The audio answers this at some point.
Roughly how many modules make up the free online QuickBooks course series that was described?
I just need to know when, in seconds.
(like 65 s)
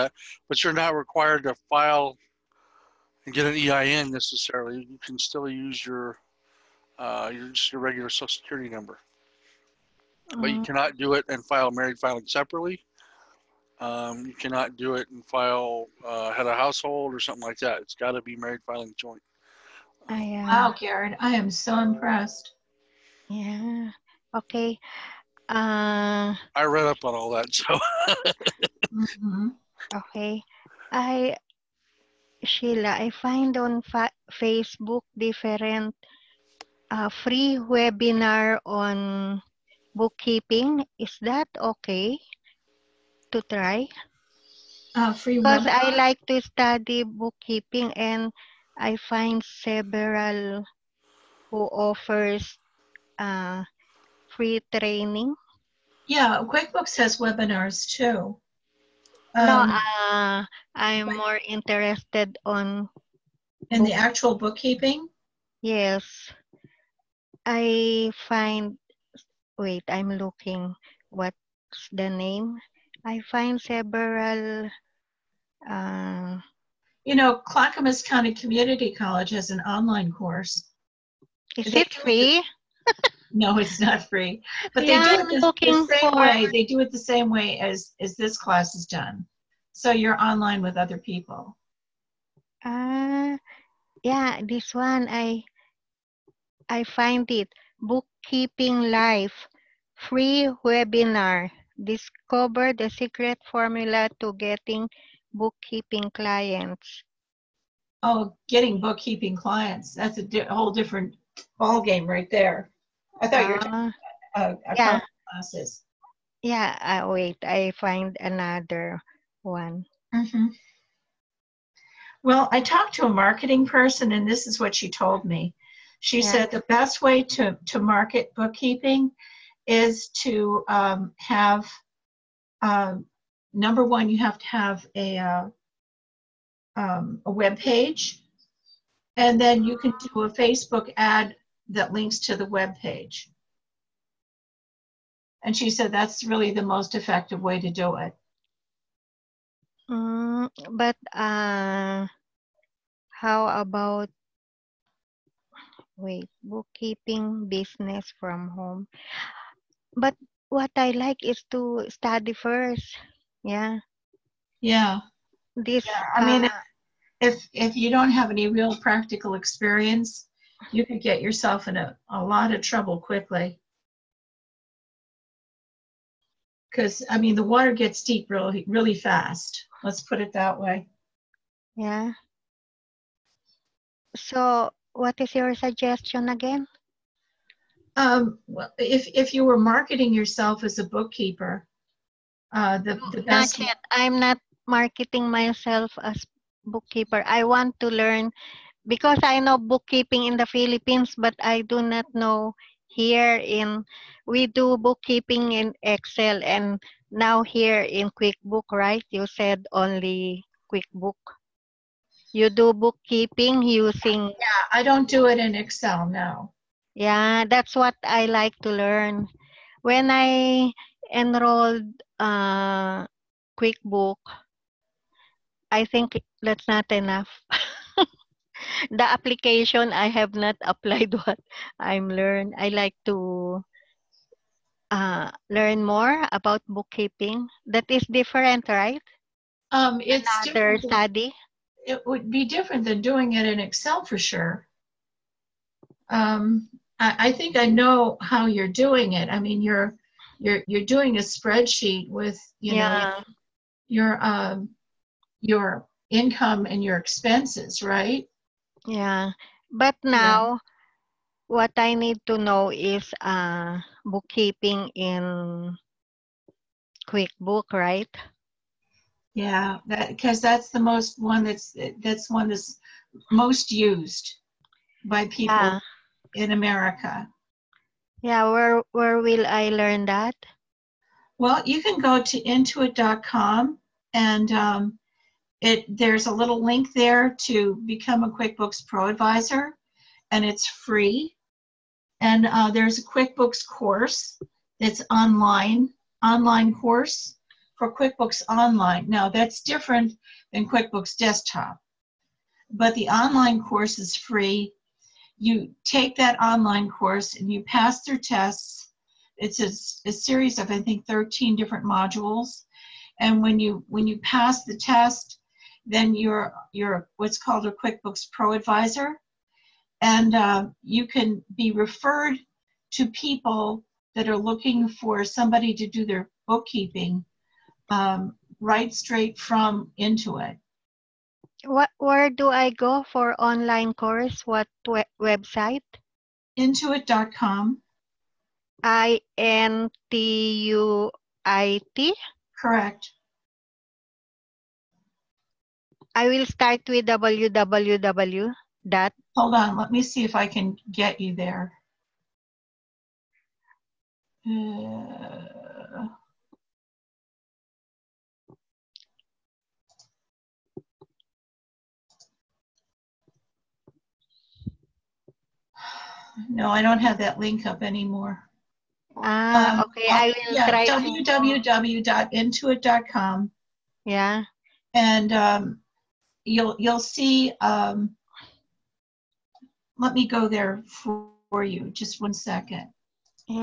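311 s.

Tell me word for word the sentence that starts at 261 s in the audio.
what I need to know is uh bookkeeping in QuickBook, right?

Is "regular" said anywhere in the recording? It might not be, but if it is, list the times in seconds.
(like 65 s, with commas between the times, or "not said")
7 s.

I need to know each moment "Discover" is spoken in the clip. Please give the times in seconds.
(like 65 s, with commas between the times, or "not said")
101 s.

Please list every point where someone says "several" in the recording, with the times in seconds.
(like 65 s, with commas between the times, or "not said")
49 s, 73 s.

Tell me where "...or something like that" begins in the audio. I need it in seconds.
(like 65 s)
17 s.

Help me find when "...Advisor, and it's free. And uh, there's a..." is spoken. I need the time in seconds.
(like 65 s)
289 s.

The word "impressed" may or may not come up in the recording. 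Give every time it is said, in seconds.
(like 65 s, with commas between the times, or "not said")
21 s.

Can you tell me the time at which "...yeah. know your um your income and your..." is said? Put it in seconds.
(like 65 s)
252 s.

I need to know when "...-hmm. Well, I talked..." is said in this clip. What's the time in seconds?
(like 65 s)
120 s.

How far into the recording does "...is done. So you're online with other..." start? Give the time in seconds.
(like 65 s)
88 s.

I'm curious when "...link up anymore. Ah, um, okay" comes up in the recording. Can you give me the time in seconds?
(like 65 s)
367 s.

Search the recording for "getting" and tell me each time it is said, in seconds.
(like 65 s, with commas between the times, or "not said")
104 s, 108 s.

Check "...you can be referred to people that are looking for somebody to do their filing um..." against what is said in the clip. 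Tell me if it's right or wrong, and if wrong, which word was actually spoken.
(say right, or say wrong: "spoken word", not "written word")
wrong: "bookkeeping", not "filing".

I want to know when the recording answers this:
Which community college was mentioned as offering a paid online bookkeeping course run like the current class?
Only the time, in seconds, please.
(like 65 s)
77 s.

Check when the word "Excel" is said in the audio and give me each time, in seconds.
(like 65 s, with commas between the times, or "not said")
205 s, 215 s, 243 s.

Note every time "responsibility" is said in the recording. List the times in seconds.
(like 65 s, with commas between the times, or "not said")
not said.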